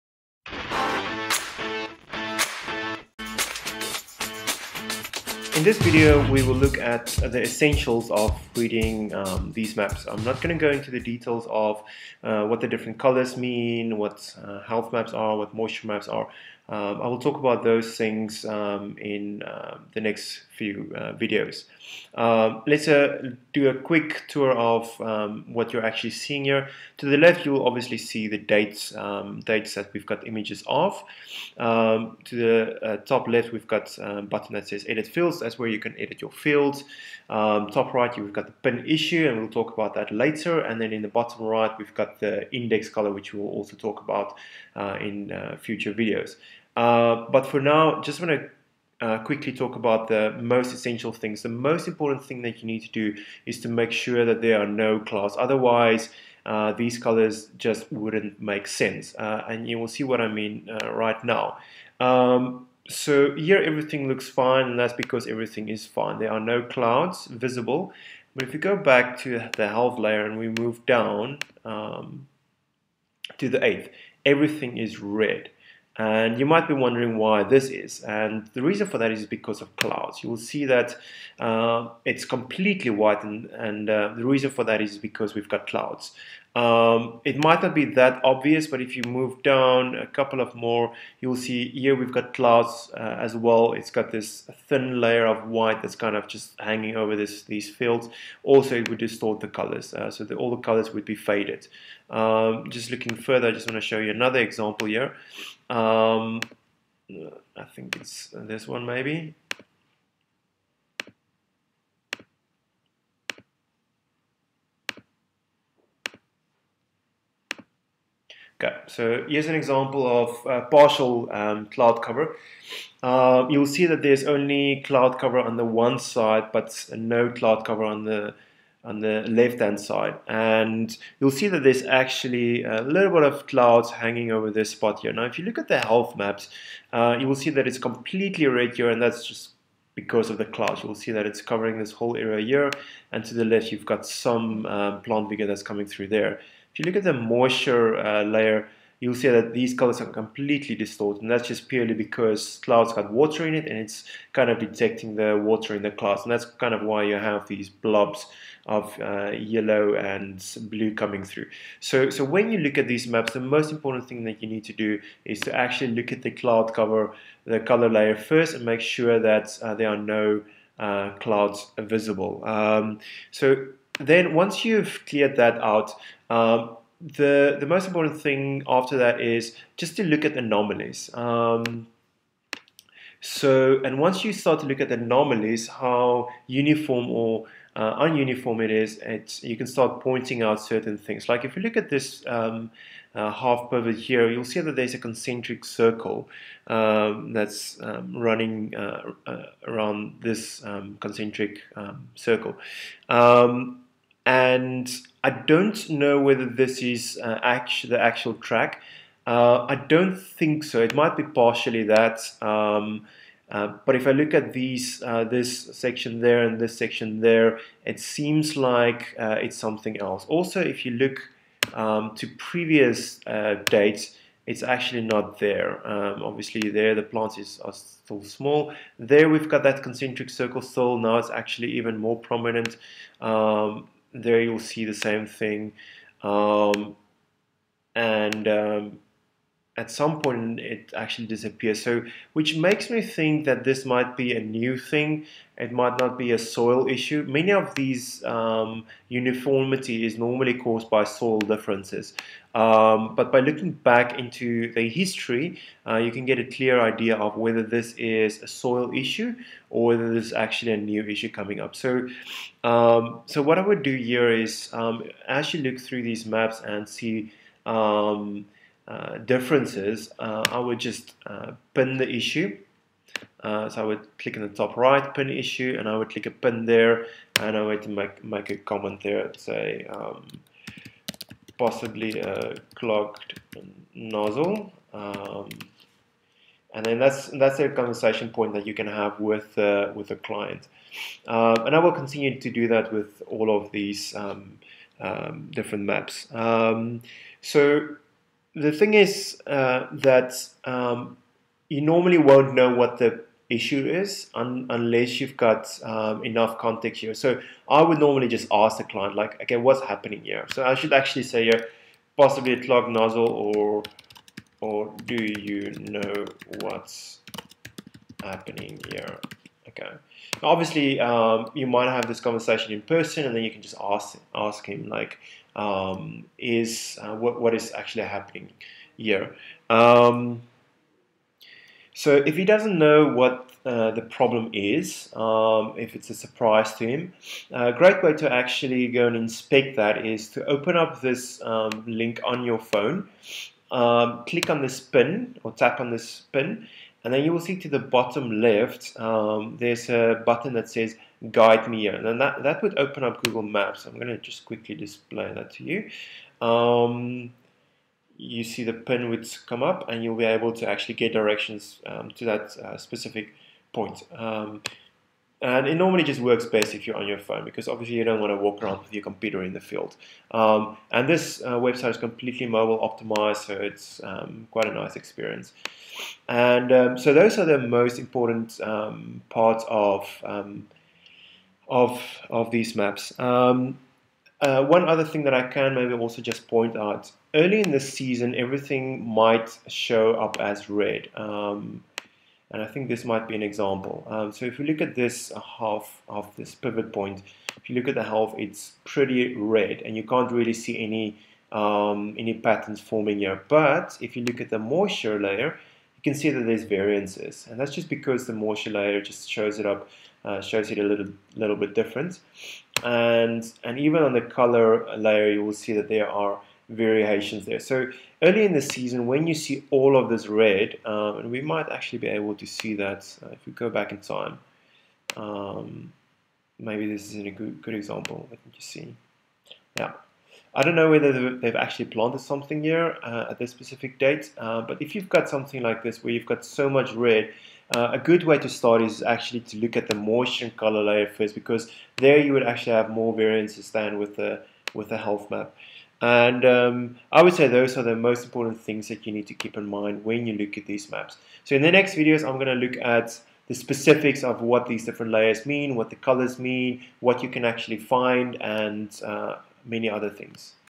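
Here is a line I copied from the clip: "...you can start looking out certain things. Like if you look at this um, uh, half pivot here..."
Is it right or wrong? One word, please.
wrong.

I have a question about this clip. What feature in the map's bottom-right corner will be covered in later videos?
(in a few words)
index color.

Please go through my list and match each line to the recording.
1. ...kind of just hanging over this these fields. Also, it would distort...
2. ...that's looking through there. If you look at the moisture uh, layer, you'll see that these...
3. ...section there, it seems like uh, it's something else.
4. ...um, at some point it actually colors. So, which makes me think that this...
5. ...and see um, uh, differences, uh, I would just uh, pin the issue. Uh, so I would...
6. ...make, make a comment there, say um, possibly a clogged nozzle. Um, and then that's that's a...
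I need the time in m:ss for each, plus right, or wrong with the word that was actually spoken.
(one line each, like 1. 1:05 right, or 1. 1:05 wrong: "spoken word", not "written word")
1. 1:35 right
2. 2:25 wrong: "coming", not "looking"
3. 3:36 right
4. 3:58 wrong: "disappears", not "colors"
5. 4:26 right
6. 4:37 right.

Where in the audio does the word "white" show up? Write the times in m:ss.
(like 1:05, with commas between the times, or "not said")
1:22, 1:35.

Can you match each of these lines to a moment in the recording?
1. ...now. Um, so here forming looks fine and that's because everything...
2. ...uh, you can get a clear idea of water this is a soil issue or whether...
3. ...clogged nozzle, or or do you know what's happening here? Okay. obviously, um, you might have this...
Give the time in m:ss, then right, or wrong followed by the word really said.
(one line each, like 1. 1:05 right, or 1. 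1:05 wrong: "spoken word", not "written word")
1. 1:01 wrong: "everything", not "forming"
2. 4:15 wrong: "whether", not "water"
3. 5:12 right.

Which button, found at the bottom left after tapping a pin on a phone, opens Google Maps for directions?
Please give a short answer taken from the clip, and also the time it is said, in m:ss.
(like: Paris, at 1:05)
guide me here, at 5:51.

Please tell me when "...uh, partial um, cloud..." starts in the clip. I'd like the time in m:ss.
2:00.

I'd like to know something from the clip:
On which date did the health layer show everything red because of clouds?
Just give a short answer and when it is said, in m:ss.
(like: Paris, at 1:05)
the 8th, at 1:13.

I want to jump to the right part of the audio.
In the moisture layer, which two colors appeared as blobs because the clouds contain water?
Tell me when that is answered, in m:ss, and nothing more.
2:39.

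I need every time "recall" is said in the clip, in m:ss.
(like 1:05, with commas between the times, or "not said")
not said.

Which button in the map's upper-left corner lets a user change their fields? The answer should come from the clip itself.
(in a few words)
Edit Fields.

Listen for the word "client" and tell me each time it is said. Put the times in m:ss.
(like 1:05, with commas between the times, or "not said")
4:50, 5:08.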